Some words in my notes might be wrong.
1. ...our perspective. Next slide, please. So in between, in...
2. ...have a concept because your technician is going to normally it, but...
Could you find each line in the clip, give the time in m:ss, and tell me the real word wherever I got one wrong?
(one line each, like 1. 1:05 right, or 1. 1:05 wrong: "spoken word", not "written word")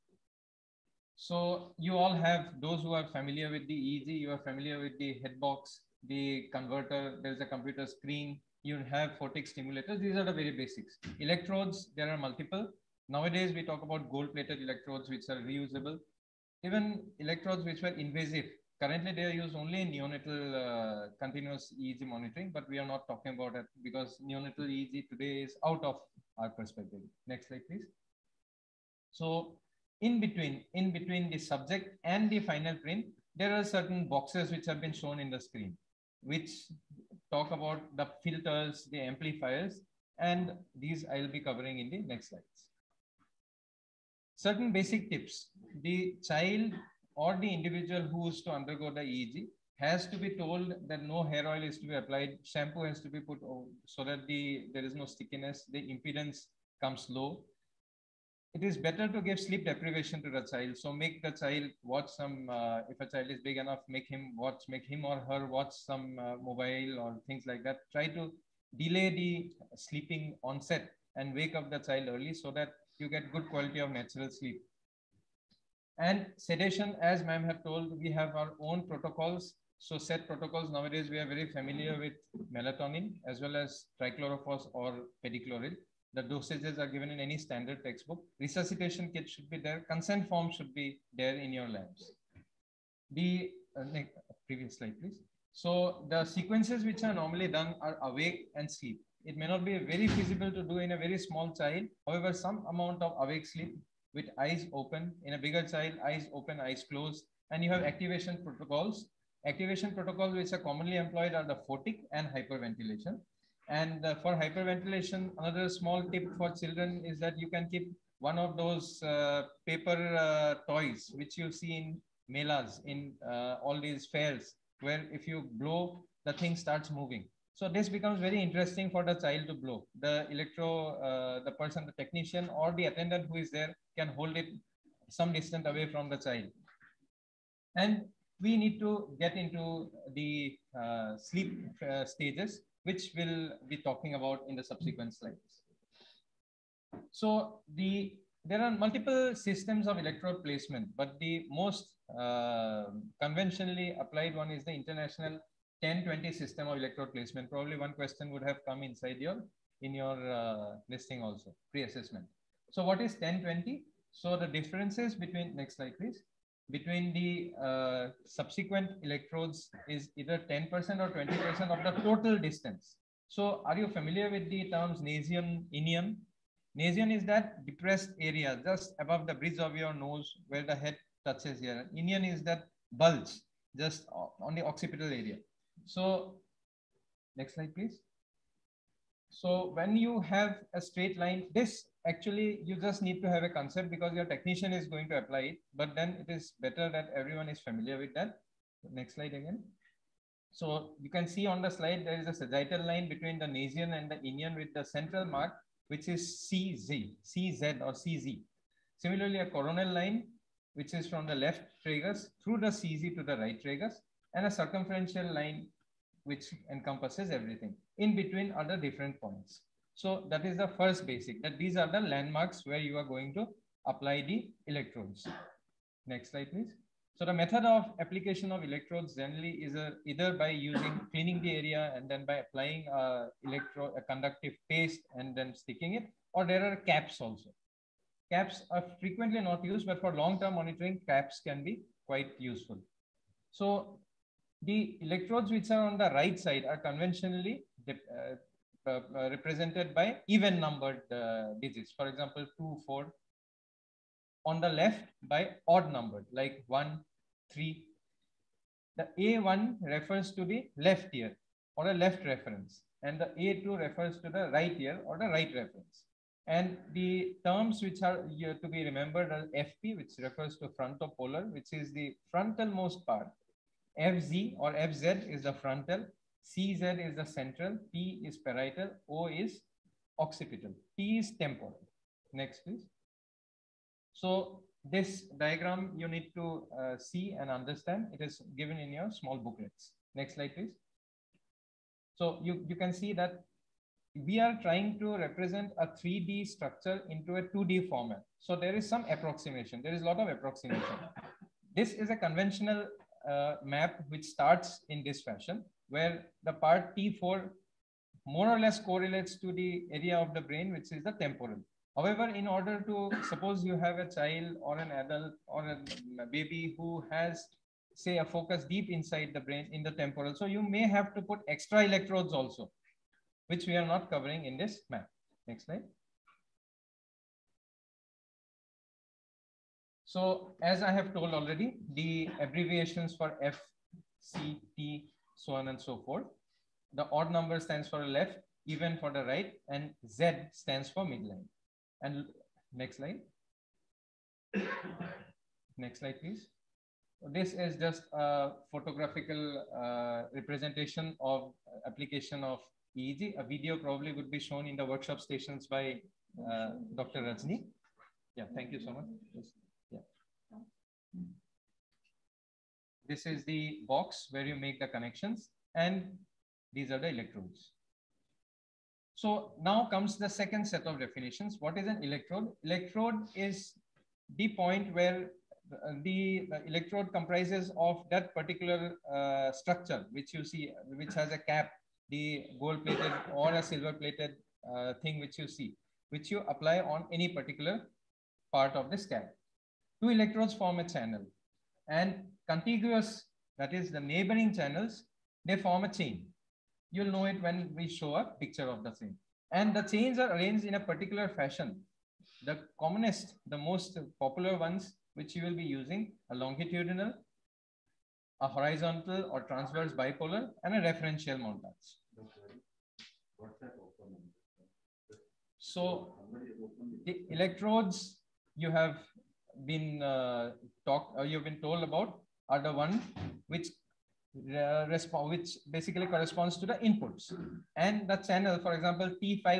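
1. 0:26 right
2. 3:13 wrong: "apply", not "normally".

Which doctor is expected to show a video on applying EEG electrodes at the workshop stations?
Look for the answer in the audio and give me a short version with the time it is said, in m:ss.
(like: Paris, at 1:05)
Dr. Rajni, at 5:56.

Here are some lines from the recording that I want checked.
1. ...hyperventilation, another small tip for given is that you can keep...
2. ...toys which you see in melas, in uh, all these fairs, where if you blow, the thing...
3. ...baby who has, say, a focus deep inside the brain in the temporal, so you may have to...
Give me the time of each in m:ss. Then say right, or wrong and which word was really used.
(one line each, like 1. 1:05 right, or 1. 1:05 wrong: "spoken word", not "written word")
1. 1:54 wrong: "children", not "given"
2. 2:00 right
3. 5:16 right.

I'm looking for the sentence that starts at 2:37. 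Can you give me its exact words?
Probably one question would have come inside your in your uh, listing also pre-assessment.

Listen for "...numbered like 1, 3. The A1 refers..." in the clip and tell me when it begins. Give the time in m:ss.
4:15.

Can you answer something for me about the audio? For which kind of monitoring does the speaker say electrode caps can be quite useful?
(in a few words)
Long-term monitoring.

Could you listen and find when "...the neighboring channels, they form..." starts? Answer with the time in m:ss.
6:33.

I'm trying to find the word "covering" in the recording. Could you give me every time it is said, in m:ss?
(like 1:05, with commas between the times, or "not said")
0:41, 5:24.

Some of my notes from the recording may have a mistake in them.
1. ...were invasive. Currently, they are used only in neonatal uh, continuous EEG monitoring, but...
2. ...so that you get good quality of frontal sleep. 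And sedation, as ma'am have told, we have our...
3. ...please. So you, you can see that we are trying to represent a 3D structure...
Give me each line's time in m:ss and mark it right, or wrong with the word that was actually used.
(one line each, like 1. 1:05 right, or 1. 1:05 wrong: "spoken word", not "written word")
1. 0:17 right
2. 1:12 wrong: "natural", not "frontal"
3. 4:50 right.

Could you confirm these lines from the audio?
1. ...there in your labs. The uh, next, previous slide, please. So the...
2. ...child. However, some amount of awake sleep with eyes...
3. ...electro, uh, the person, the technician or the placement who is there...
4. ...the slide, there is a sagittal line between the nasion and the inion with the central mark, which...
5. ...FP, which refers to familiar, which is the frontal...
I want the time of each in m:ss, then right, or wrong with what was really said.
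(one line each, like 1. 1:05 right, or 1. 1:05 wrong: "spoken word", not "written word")
1. 1:31 right
2. 1:41 right
3. 2:10 wrong: "attendant", not "placement"
4. 3:21 right
5. 4:29 wrong: "frontopolar", not "familiar".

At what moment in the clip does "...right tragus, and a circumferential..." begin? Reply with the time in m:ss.
3:33.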